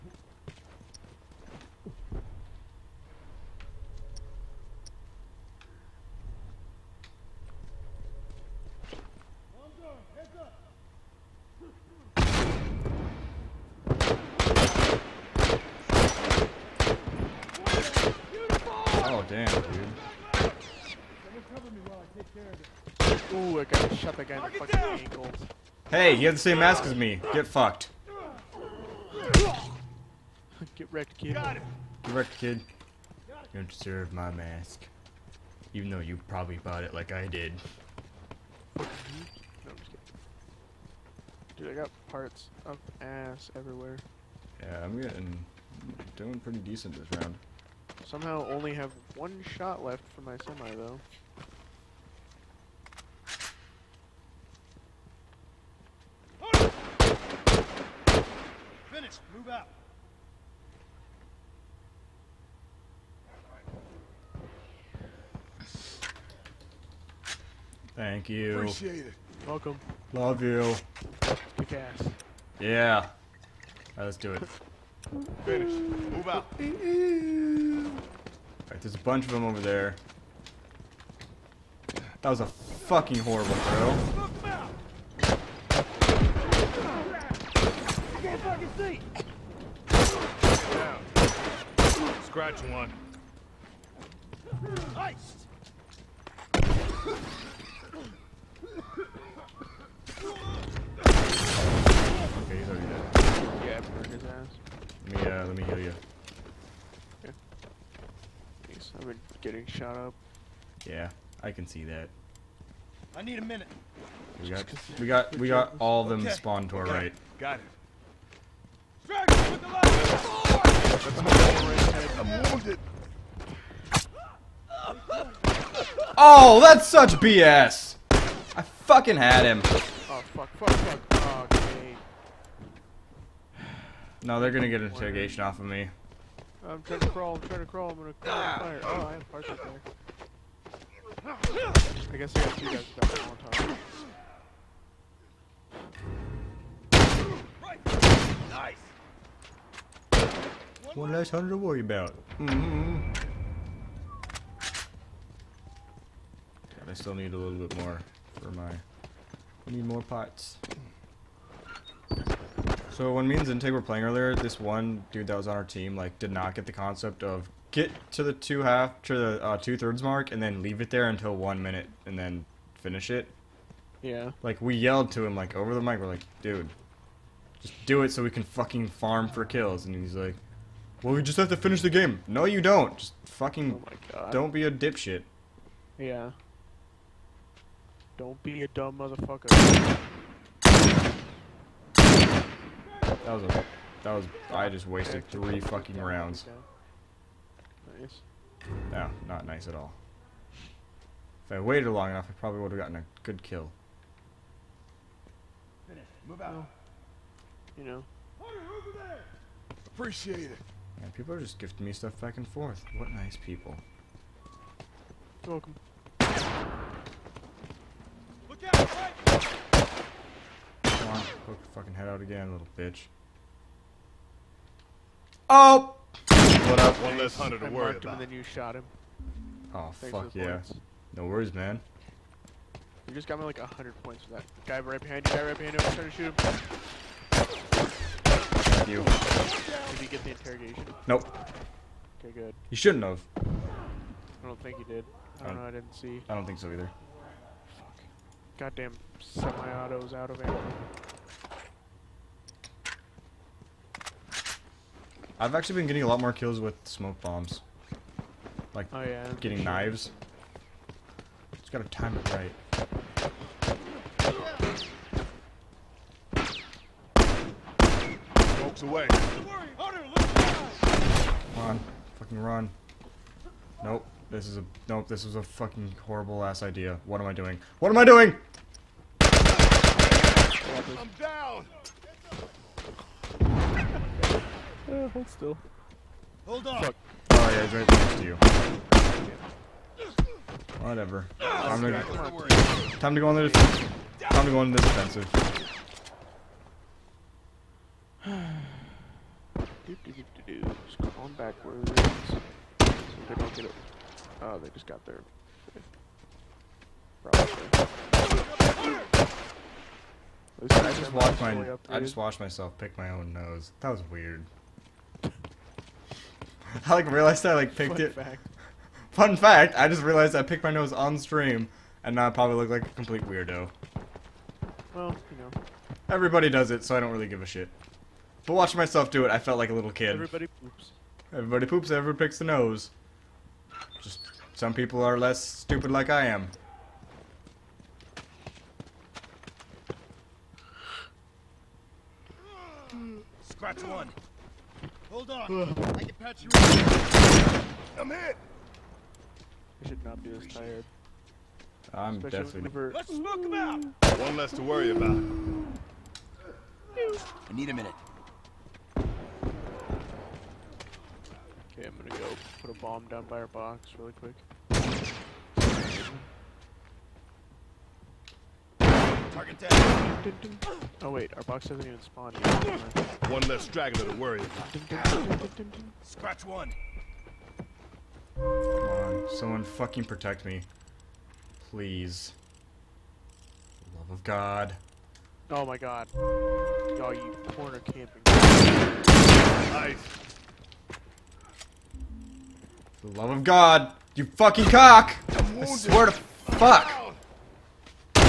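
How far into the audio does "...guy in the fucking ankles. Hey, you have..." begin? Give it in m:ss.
0:24.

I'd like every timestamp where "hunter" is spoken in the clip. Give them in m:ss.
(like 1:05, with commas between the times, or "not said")
2:31, 3:47.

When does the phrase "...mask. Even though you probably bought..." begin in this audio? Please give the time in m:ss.
0:34.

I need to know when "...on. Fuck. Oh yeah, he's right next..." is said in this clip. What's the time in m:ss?
4:46.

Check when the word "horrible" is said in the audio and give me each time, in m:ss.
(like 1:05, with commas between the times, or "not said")
1:23, 4:36.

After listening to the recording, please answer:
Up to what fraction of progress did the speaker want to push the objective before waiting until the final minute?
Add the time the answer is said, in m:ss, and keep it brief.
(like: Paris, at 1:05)
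Two thirds, at 2:49.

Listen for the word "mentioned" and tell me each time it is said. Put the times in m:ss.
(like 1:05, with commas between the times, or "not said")
not said.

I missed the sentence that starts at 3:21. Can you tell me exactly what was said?
If I waited long enough, I probably would have gotten a good kill.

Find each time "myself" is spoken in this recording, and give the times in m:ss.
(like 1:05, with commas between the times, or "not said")
5:12, 5:28.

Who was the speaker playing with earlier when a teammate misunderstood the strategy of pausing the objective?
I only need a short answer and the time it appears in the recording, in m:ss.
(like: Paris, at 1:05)
Zintig, at 2:43.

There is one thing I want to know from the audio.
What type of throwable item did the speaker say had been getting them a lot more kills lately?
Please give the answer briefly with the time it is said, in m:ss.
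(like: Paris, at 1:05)
Smoke bombs, at 4:16.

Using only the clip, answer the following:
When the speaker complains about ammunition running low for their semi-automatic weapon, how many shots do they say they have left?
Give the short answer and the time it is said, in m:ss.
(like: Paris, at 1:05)
1, at 0:49.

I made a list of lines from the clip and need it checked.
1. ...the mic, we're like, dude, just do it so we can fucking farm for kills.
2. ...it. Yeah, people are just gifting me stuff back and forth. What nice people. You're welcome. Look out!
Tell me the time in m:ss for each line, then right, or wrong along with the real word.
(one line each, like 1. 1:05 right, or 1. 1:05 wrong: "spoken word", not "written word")
1. 2:55 right
2. 3:30 right.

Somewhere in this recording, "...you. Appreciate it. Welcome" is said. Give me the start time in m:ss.
1:08.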